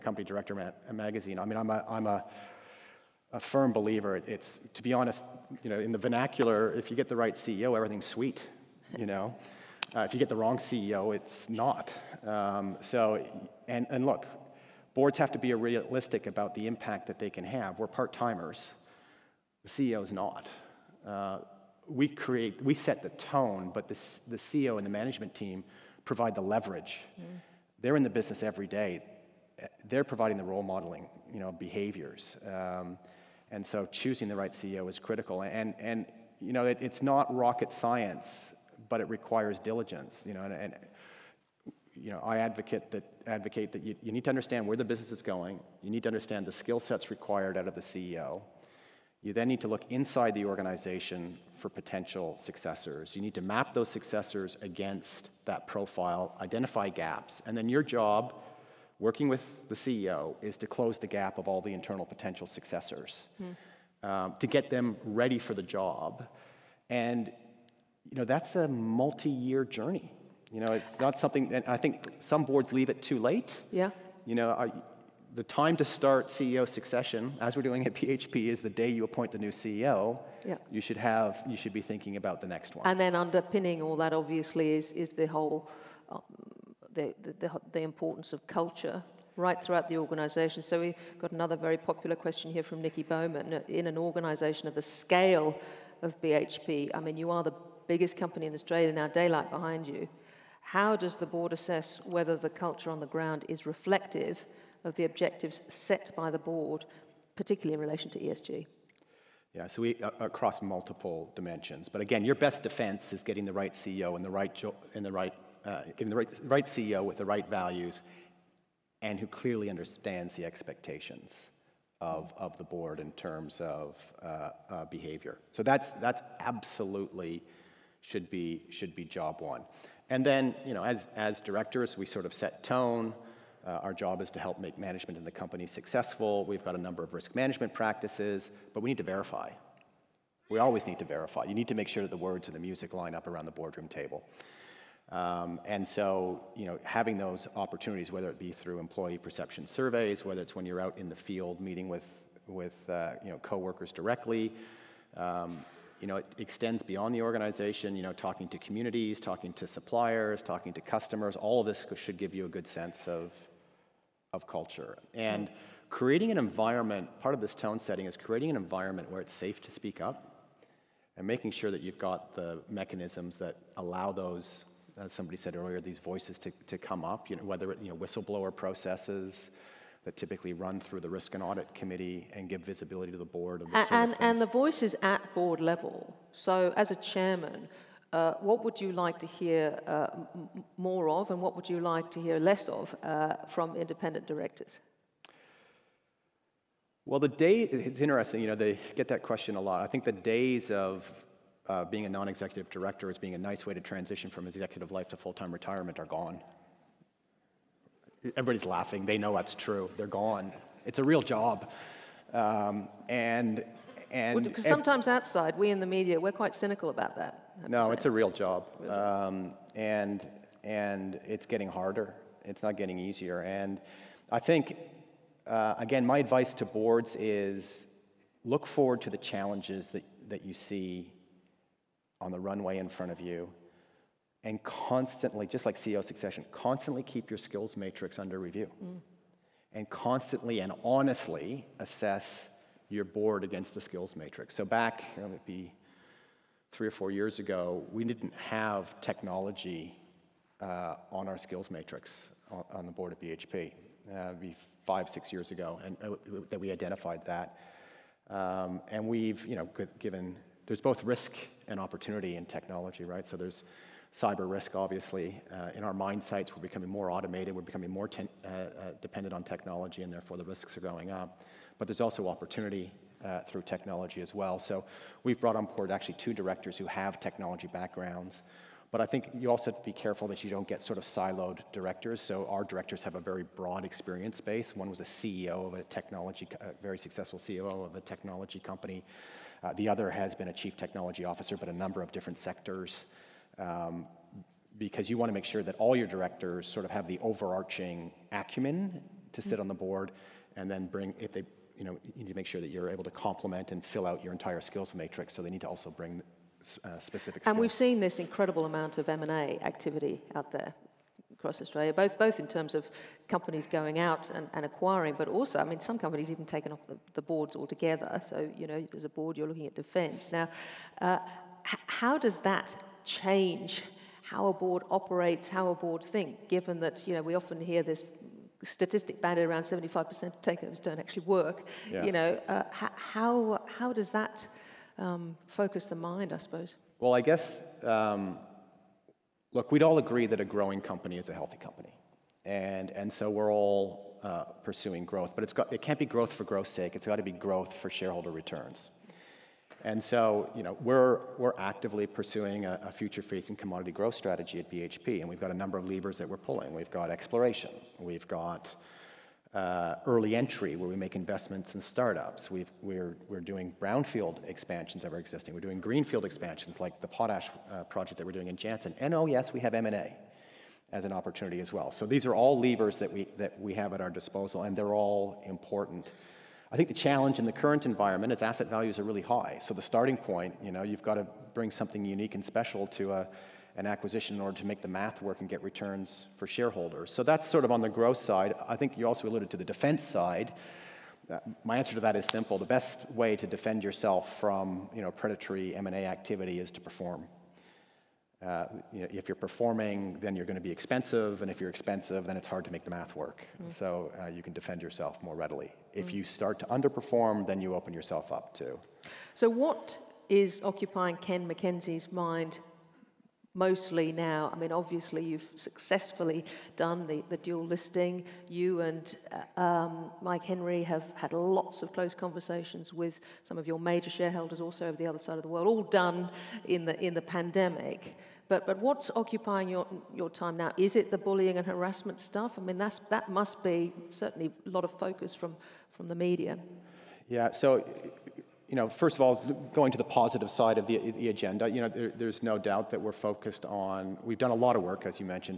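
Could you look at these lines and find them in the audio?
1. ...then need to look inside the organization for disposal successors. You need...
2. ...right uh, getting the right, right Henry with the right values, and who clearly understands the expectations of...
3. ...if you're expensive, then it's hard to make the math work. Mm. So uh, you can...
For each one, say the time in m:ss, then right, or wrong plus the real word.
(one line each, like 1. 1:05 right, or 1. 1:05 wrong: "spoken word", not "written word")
1. 0:49 wrong: "potential", not "disposal"
2. 1:55 wrong: "CEO", not "Henry"
3. 6:41 right.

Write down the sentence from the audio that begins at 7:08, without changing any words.
But, but what's occupying your, your time now?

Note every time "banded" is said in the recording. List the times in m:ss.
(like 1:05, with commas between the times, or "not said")
5:29.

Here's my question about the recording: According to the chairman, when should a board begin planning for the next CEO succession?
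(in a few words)
The day you appoint the new CEO.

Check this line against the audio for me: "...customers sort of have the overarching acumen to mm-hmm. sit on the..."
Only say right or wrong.
wrong.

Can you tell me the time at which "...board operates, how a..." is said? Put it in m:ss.
5:24.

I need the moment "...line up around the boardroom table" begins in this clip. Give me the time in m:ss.
2:22.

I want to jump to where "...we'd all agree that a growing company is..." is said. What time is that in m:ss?
5:39.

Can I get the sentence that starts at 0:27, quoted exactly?
They're in the business every day.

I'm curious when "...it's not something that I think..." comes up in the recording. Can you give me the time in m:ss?
1:10.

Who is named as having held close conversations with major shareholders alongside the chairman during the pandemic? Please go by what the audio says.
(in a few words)
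Mike Henry.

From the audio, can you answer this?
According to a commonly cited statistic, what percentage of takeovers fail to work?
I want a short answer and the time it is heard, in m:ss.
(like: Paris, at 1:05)
75%, at 5:29.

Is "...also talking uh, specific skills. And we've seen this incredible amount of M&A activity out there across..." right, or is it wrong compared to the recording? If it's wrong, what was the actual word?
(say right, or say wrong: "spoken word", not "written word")
wrong: "bring", not "talking".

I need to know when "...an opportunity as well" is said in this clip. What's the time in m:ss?
6:11.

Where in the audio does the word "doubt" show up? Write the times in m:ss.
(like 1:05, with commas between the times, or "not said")
7:22.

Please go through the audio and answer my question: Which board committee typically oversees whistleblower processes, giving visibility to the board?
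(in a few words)
Risk and audit committee.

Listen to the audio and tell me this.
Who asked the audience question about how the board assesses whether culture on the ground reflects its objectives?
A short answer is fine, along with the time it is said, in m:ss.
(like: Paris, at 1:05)
Nikki Bowman, at 1:32.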